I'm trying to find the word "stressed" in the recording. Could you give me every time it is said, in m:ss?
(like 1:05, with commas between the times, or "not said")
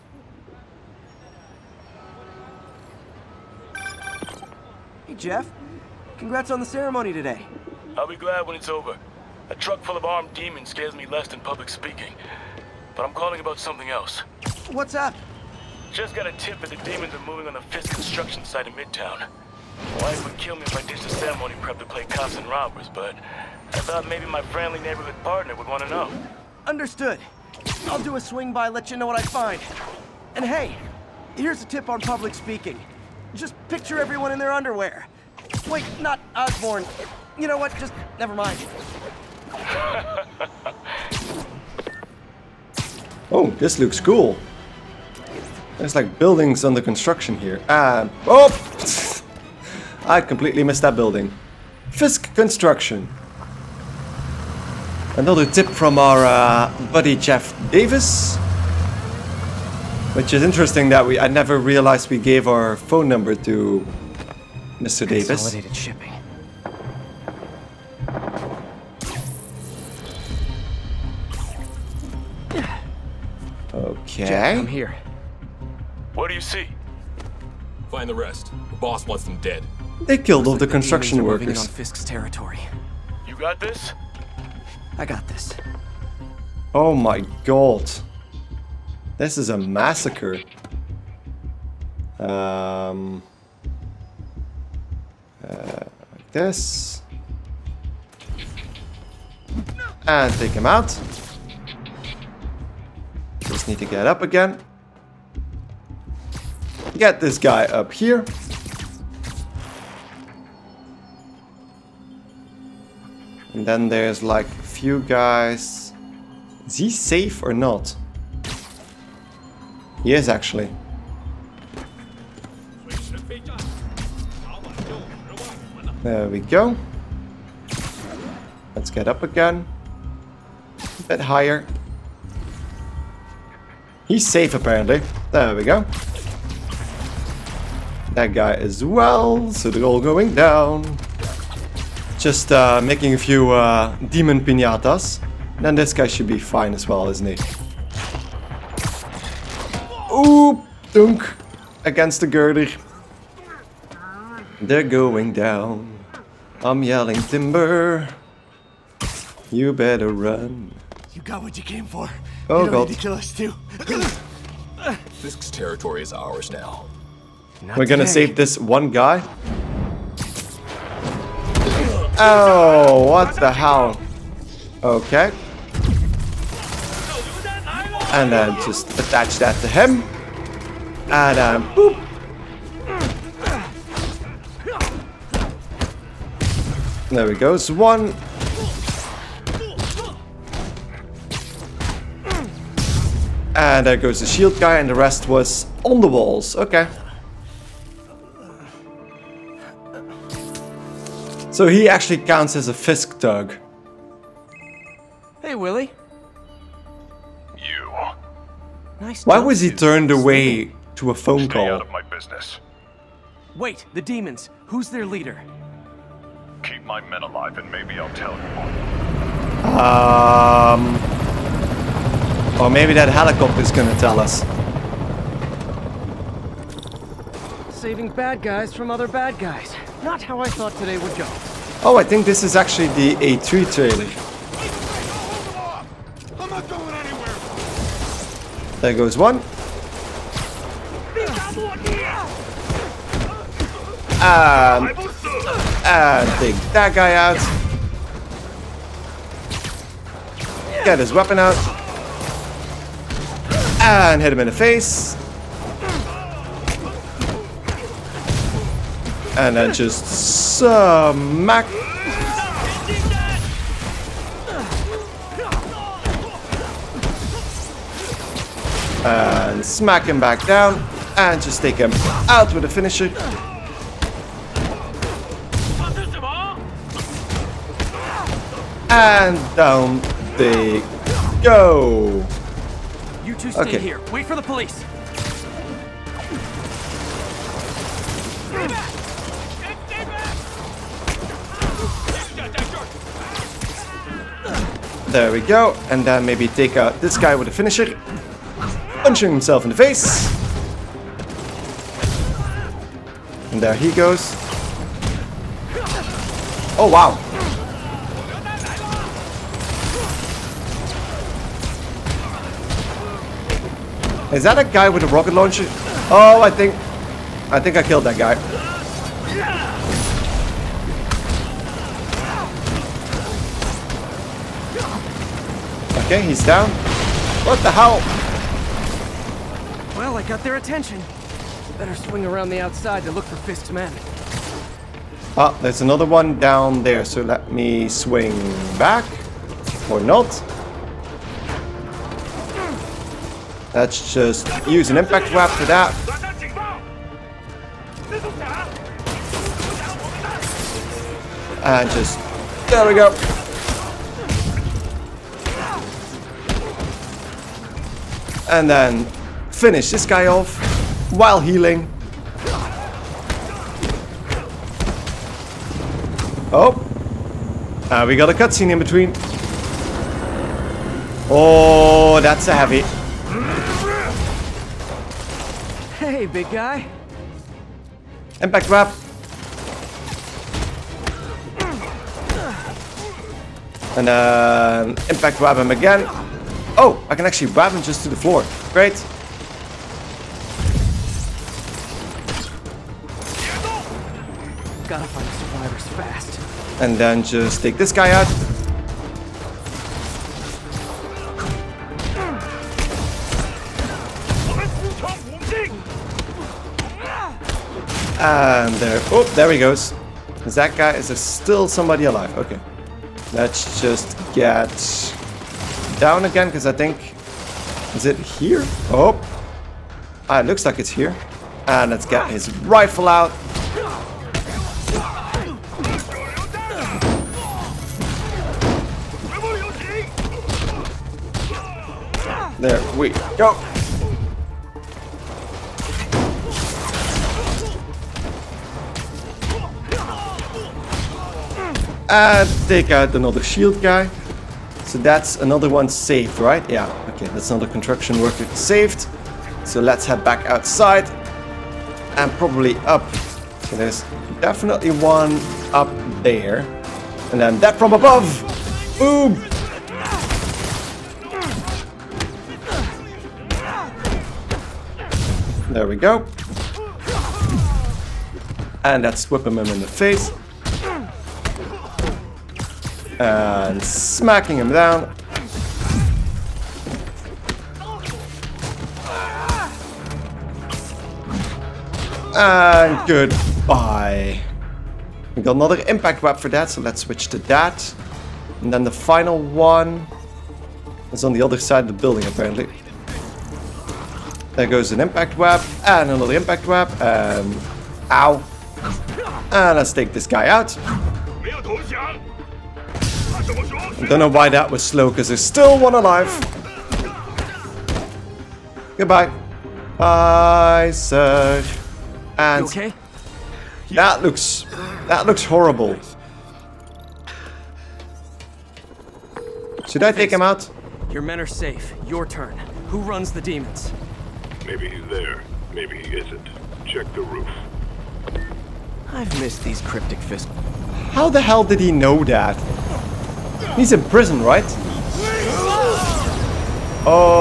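not said.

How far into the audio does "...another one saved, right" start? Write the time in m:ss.
7:25.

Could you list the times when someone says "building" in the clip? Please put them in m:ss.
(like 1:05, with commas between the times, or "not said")
0:46, 0:50, 8:12.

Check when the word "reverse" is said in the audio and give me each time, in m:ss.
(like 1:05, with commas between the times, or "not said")
not said.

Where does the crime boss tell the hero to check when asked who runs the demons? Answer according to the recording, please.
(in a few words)
the roof.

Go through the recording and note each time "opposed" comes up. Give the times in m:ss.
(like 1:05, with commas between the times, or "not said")
not said.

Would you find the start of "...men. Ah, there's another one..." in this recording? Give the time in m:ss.
5:33.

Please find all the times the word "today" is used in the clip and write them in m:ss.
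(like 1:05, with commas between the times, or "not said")
0:07, 2:48, 3:50.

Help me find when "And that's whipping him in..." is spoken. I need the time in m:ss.
7:48.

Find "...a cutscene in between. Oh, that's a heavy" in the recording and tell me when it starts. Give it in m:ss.
6:08.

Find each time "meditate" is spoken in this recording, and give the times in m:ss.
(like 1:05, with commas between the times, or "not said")
not said.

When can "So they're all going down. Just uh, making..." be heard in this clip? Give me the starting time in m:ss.
2:19.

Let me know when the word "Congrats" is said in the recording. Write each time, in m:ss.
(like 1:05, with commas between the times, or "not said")
0:06.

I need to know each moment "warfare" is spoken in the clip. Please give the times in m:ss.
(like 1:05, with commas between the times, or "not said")
not said.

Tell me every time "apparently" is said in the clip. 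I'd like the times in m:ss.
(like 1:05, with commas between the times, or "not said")
2:14, 8:12.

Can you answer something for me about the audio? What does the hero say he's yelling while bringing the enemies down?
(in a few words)
timber.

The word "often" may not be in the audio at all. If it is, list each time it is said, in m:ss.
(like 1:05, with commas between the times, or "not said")
not said.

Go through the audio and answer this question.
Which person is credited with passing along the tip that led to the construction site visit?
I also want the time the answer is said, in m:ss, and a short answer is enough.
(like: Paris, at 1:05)
Jeff Davis, at 0:57.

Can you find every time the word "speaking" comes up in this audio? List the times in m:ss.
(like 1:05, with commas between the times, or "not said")
0:11, 0:32.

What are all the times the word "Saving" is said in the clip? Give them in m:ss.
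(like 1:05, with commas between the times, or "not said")
3:47.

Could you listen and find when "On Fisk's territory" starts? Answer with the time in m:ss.
1:21.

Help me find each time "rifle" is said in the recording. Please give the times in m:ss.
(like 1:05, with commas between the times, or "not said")
7:02.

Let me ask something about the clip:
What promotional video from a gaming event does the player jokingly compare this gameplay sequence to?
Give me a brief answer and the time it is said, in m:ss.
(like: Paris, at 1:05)
E3 trailer, at 3:53.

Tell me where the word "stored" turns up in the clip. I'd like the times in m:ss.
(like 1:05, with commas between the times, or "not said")
not said.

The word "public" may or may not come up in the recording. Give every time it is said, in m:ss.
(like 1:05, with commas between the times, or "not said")
0:11, 0:32.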